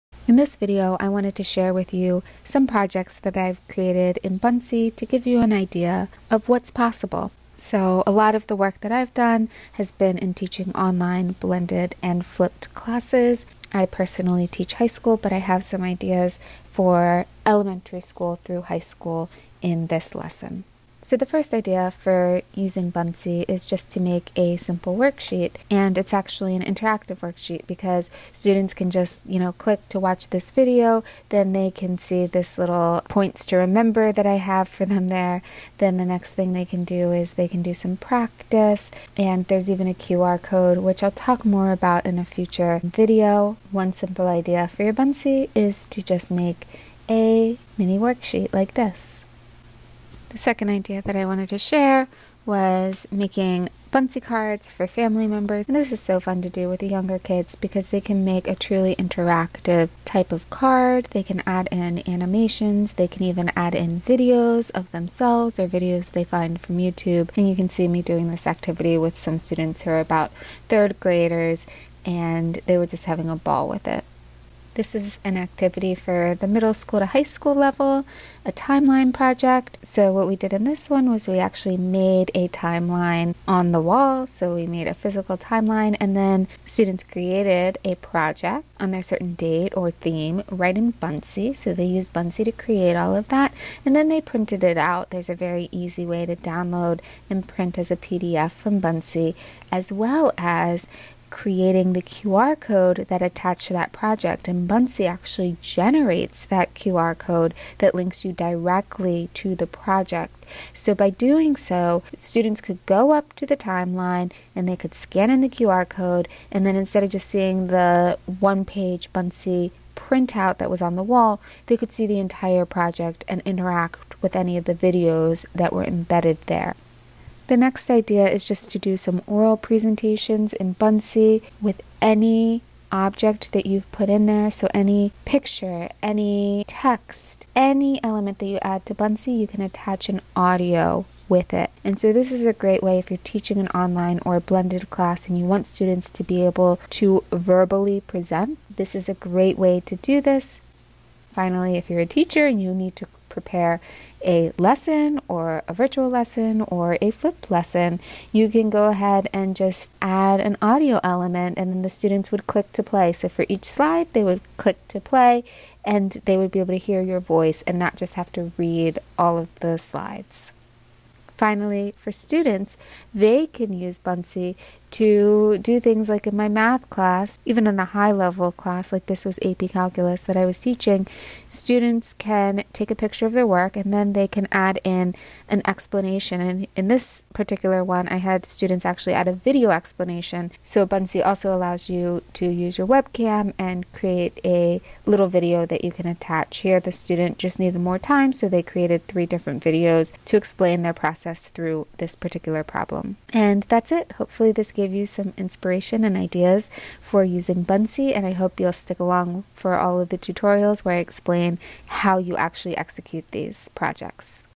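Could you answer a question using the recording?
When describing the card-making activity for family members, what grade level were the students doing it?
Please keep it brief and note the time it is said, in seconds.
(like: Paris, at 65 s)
third graders, at 70 s.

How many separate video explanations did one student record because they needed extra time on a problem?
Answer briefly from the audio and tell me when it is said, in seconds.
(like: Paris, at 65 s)
3, at 199 s.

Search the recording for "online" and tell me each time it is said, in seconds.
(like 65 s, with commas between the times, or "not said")
10 s, 143 s.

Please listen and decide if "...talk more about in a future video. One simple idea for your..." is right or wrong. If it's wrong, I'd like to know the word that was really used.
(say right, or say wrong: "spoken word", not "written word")
right.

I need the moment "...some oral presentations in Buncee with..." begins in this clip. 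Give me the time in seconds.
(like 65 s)
128 s.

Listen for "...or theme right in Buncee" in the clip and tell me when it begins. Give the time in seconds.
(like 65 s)
89 s.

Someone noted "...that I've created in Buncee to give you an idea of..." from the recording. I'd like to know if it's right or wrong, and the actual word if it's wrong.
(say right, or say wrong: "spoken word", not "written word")
right.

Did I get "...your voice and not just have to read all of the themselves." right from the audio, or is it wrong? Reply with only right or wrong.
wrong.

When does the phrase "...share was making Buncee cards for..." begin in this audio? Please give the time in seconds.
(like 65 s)
51 s.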